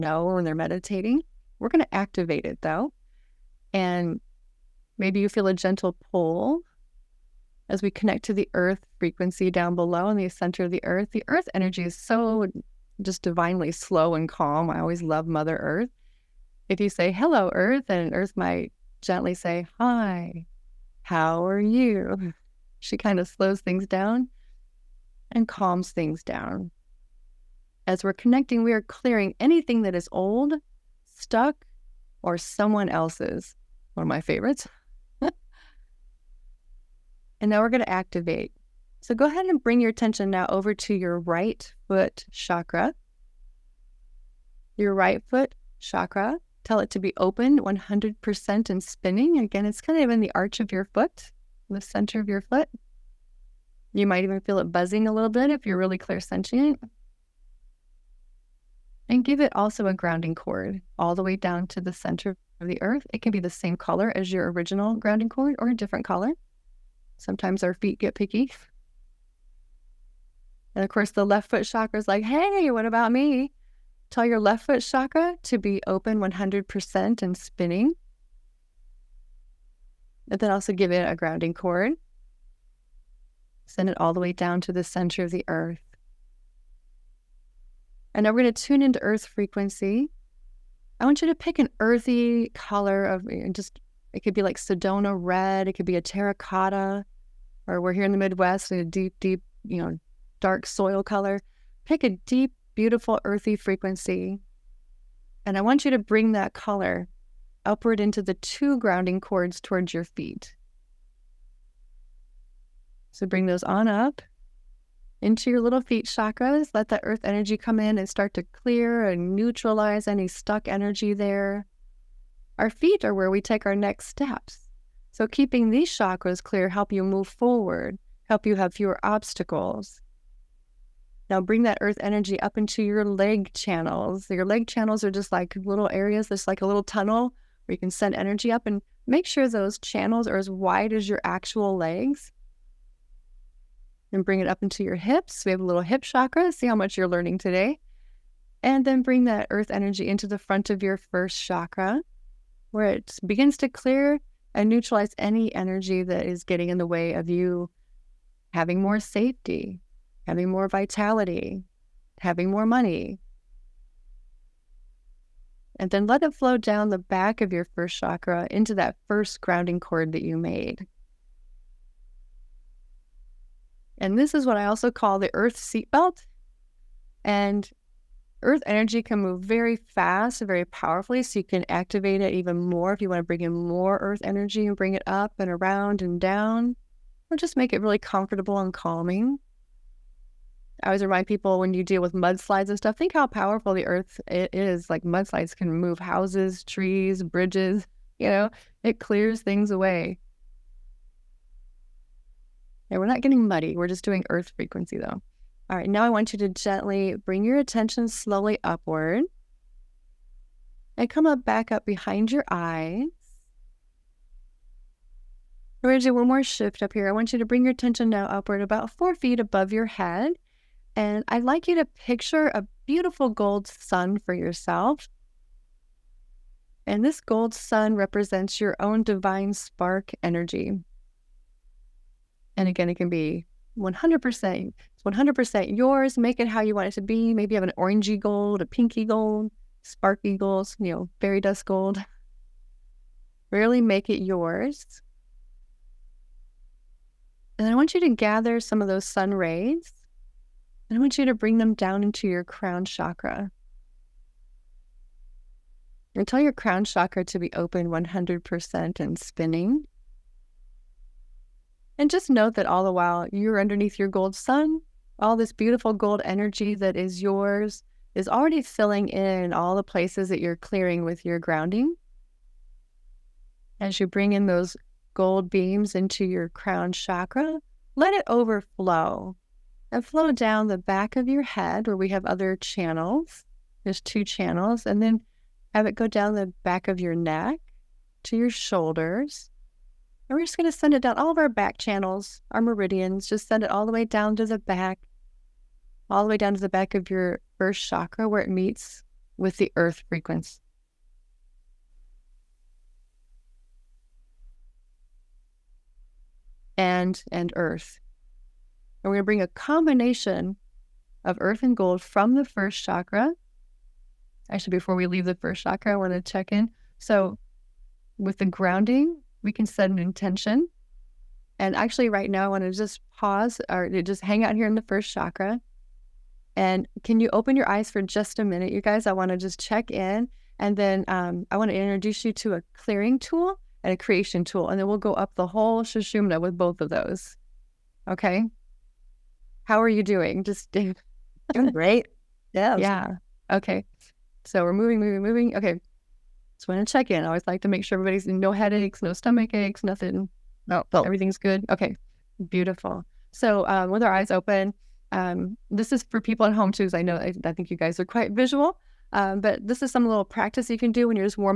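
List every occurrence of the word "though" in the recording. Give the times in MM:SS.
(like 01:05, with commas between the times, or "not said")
00:02, 03:24.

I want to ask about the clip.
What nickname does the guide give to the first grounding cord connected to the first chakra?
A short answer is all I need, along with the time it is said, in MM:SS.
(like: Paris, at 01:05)
Earth seatbelt, at 02:55.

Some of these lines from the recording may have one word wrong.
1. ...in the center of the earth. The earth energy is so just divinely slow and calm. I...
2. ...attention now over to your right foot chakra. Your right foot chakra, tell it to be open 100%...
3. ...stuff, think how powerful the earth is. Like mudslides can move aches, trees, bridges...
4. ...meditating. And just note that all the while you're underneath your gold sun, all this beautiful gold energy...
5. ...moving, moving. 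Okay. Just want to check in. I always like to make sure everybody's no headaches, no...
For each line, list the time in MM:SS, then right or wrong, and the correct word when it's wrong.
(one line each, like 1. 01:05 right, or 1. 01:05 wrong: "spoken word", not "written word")
1. 00:10 right
2. 00:39 right
3. 03:12 wrong: "houses", not "aches"
4. 04:19 wrong: "spinning", not "meditating"
5. 05:44 right.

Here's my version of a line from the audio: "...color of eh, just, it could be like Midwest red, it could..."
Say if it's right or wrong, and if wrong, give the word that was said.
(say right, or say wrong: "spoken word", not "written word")
wrong: "Sedona", not "Midwest".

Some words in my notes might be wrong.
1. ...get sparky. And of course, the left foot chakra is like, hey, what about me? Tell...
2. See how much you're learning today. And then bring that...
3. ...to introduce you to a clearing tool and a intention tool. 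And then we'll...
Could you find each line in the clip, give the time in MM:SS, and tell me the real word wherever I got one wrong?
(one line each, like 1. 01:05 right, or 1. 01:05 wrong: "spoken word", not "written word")
1. 01:07 wrong: "picky", not "sparky"
2. 02:26 right
3. 05:31 wrong: "creation", not "intention".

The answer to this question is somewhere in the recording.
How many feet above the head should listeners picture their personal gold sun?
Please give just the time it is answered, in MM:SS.
03:38.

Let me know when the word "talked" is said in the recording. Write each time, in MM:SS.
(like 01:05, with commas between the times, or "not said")
not said.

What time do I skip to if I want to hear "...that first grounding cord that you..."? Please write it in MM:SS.
02:48.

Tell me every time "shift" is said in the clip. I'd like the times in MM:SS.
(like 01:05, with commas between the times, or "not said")
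03:36.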